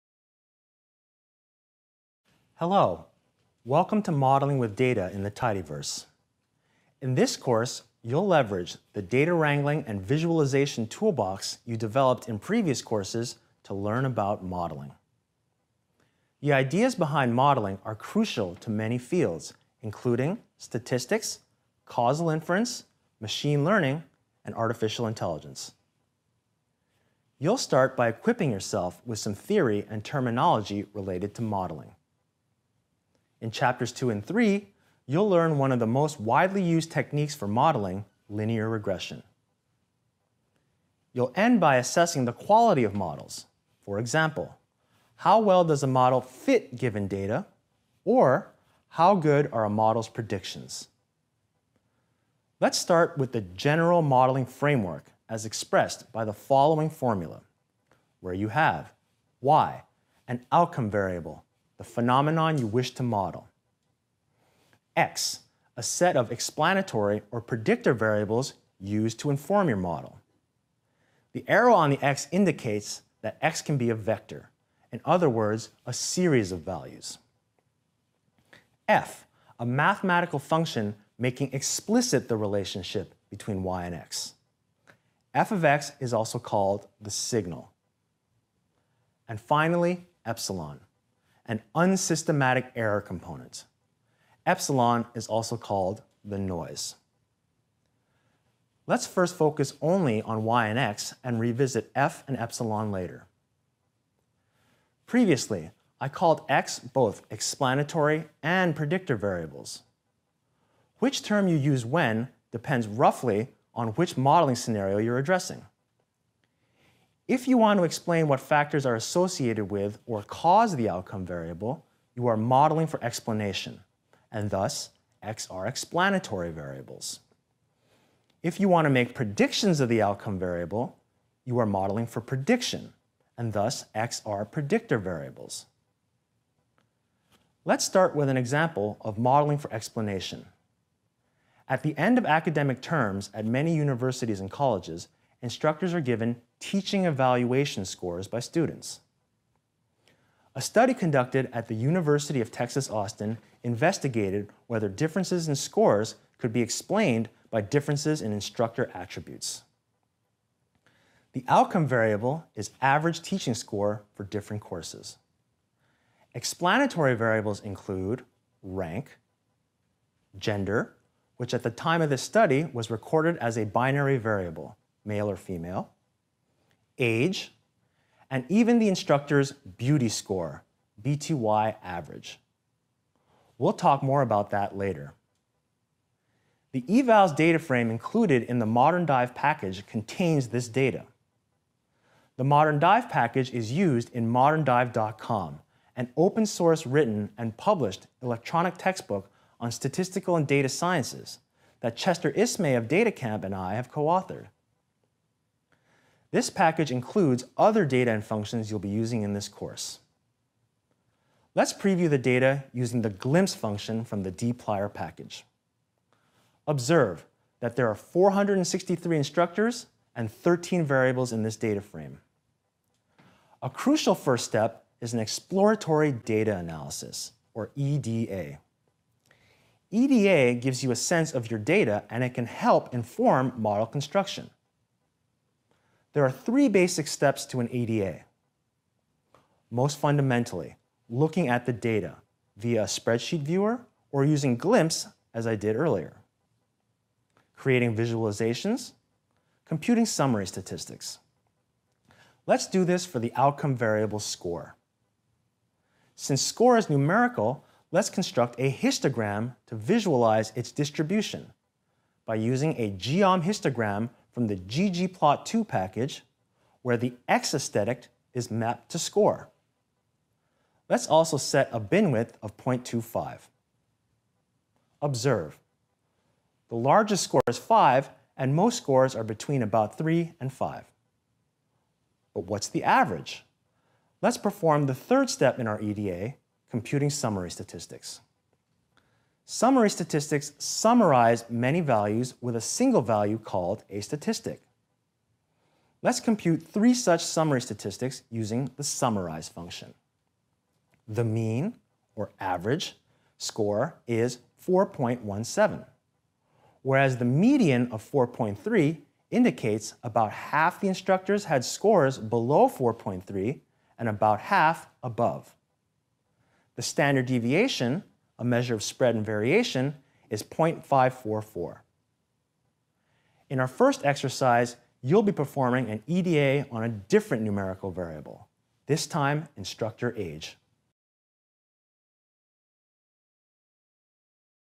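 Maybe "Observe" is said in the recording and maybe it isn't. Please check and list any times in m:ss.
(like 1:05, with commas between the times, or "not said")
3:36, 4:35.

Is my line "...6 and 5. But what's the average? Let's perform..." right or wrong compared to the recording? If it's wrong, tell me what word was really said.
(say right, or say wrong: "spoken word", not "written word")
wrong: "3", not "6".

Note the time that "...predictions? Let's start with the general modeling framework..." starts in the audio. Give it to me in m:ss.
0:50.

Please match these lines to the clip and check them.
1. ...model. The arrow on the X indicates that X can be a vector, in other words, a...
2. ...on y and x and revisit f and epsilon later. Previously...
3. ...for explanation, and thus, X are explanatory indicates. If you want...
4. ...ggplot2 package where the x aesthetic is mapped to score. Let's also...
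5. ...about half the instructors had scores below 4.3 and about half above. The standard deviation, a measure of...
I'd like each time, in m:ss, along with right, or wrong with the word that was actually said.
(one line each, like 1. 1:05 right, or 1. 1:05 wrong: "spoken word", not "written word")
1. 1:09 right
2. 1:40 right
3. 2:02 wrong: "variables", not "indicates"
4. 4:24 right
5. 5:10 right.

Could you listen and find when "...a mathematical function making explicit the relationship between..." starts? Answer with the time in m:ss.
1:19.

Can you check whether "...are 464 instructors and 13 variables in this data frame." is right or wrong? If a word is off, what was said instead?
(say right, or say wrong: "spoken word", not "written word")
wrong: "463", not "464".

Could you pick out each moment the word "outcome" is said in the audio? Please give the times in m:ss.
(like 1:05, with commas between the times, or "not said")
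1:00, 2:00, 2:10, 2:41, 4:13.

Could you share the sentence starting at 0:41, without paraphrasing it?
You'll end by assessing the quality of models.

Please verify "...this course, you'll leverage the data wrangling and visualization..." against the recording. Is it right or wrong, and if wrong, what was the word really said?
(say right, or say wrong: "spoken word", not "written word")
right.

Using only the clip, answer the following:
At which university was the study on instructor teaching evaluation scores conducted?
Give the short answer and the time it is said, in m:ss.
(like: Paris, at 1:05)
University of Texas Austin, at 2:31.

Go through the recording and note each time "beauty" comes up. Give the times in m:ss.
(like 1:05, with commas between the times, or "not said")
2:59.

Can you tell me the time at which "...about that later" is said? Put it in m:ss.
3:04.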